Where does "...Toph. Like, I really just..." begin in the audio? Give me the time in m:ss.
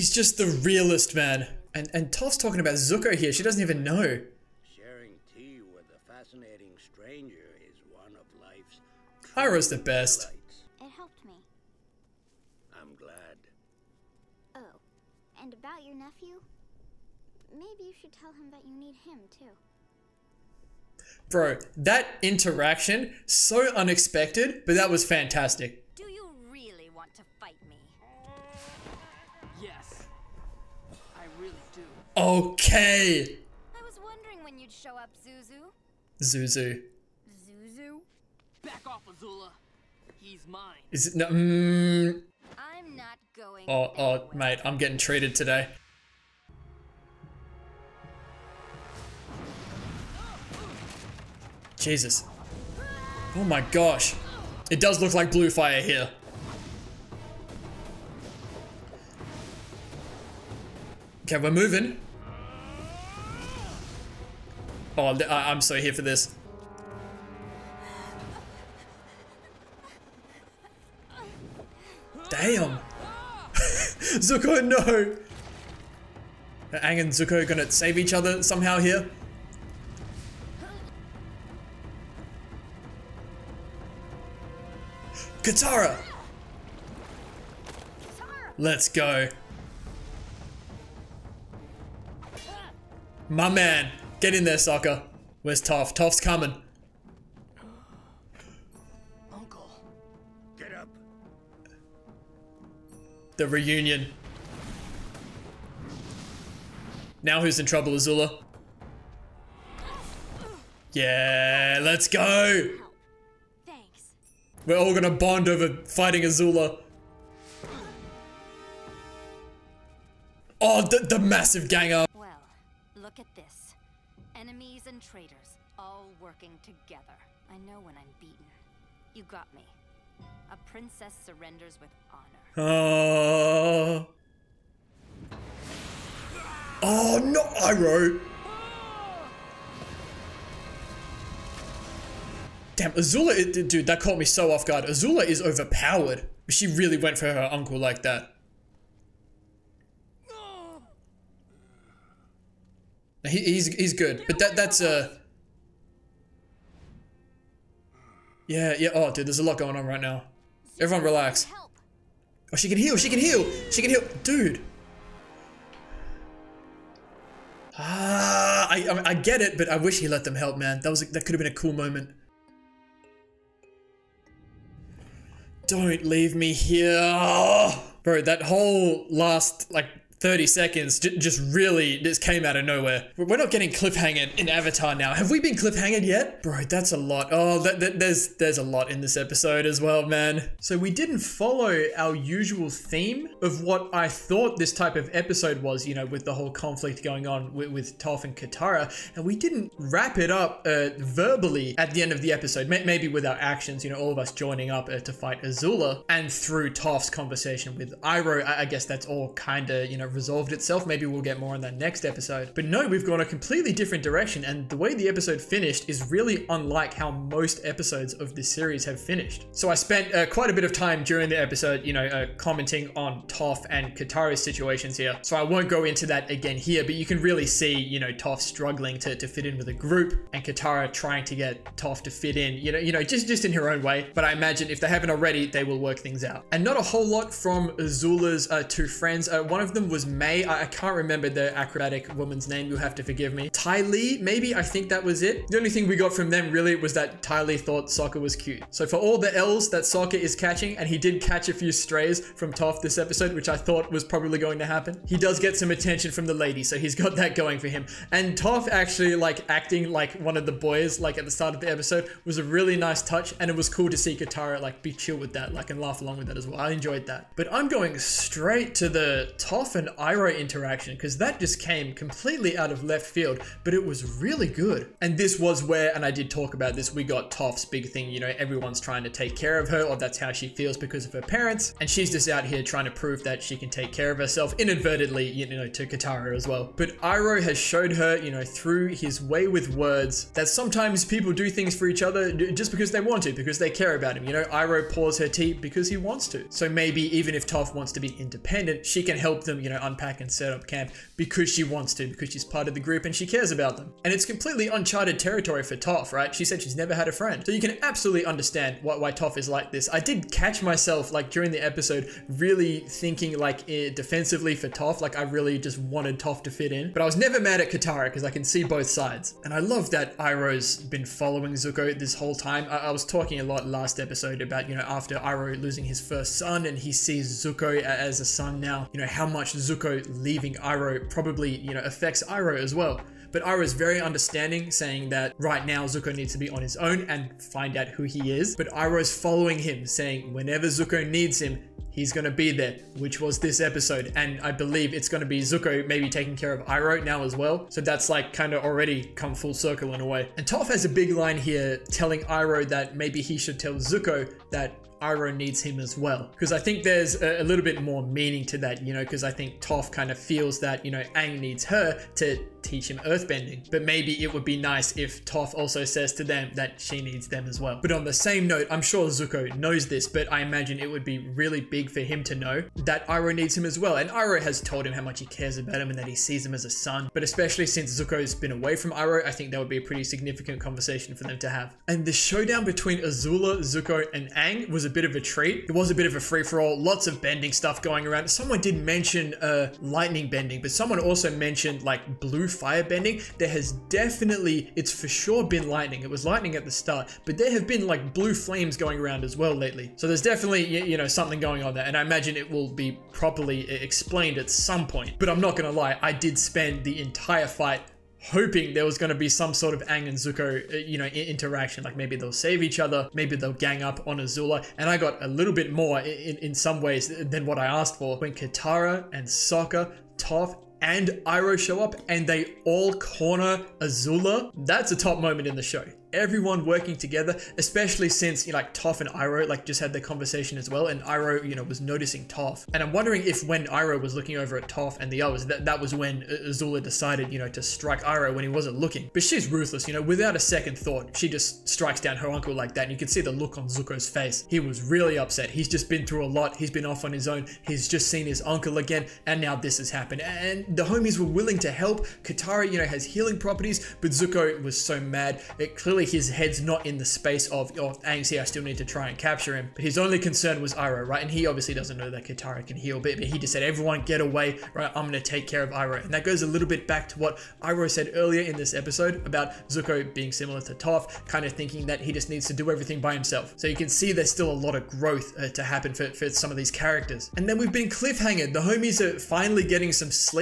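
5:14.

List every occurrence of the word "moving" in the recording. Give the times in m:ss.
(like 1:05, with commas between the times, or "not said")
1:01.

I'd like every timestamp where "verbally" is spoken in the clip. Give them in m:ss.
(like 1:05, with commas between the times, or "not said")
3:20.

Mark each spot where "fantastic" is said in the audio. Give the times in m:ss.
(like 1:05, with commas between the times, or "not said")
0:25.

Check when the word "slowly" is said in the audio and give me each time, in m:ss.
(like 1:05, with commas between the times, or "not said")
not said.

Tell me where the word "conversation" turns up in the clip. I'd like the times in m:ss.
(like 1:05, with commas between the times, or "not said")
3:27, 6:20, 7:10.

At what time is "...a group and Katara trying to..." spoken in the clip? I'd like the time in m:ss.
3:49.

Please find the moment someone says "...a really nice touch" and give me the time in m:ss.
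4:22.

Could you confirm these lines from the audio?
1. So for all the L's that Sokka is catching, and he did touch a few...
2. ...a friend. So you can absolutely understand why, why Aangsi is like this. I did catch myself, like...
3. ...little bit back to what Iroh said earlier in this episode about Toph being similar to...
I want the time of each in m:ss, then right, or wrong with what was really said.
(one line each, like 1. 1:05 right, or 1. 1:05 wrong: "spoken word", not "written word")
1. 4:08 wrong: "catch", not "touch"
2. 5:07 wrong: "Toph", not "Aangsi"
3. 7:46 wrong: "Zuko", not "Toph".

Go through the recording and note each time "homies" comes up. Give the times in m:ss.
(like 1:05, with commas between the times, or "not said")
7:30, 7:58.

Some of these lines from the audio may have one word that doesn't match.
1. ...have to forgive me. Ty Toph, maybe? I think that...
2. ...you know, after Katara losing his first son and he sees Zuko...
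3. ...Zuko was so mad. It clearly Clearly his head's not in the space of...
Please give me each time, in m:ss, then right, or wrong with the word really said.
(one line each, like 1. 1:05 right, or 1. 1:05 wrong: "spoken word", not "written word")
1. 4:02 wrong: "Lee", not "Toph"
2. 5:24 wrong: "Iroh", not "Katara"
3. 7:34 right.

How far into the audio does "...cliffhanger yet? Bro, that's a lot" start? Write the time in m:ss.
3:05.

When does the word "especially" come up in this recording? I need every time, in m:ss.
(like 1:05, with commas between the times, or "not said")
6:17, 7:07.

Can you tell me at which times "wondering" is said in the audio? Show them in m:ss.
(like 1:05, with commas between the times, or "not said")
0:34, 7:12.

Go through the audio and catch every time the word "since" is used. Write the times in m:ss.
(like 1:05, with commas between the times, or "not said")
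6:17, 7:08.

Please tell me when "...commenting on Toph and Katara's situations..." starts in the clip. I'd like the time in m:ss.
3:42.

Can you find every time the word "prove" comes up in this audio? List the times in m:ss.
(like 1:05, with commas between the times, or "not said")
4:42.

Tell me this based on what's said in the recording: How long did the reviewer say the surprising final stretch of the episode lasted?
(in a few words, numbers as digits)
30 seconds.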